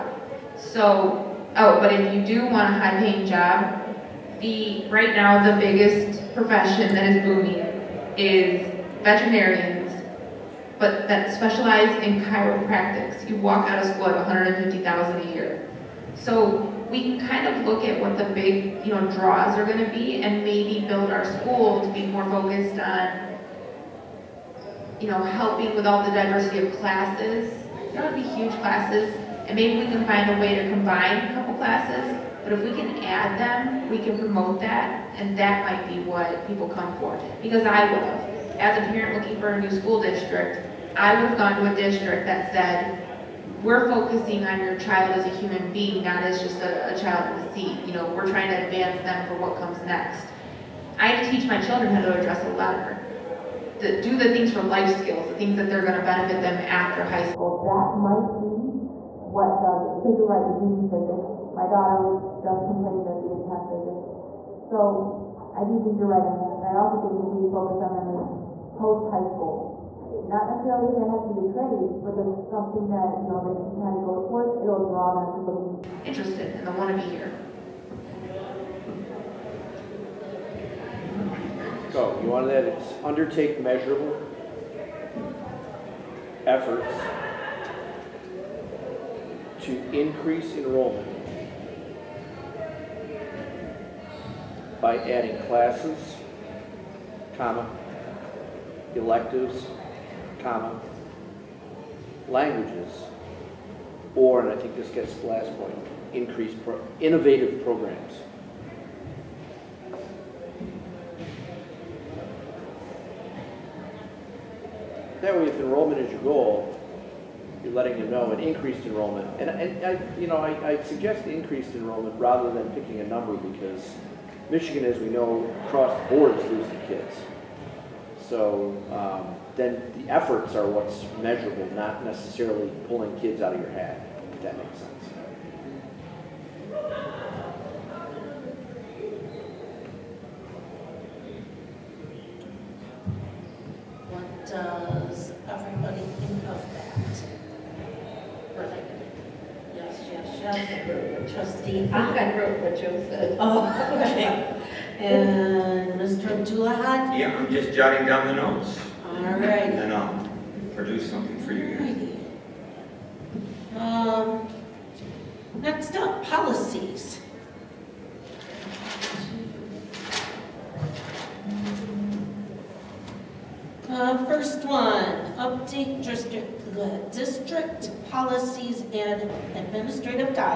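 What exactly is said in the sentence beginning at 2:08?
So um, then the efforts are what's measurable, not necessarily pulling kids out of your head.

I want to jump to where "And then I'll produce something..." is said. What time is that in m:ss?
2:39.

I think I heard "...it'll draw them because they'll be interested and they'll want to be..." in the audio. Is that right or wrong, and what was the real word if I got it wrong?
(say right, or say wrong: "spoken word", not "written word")
right.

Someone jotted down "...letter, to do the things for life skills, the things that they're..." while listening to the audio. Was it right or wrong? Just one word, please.
right.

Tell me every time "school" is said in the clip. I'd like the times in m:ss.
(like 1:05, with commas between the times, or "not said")
0:13, 0:21, 0:39, 0:57, 1:09.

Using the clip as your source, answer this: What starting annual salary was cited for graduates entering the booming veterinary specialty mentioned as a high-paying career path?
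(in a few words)
$150,000.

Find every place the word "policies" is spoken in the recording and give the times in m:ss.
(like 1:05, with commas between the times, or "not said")
2:46, 2:58.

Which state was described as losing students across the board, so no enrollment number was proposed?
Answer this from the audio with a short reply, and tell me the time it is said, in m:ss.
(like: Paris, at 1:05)
Michigan, at 2:04.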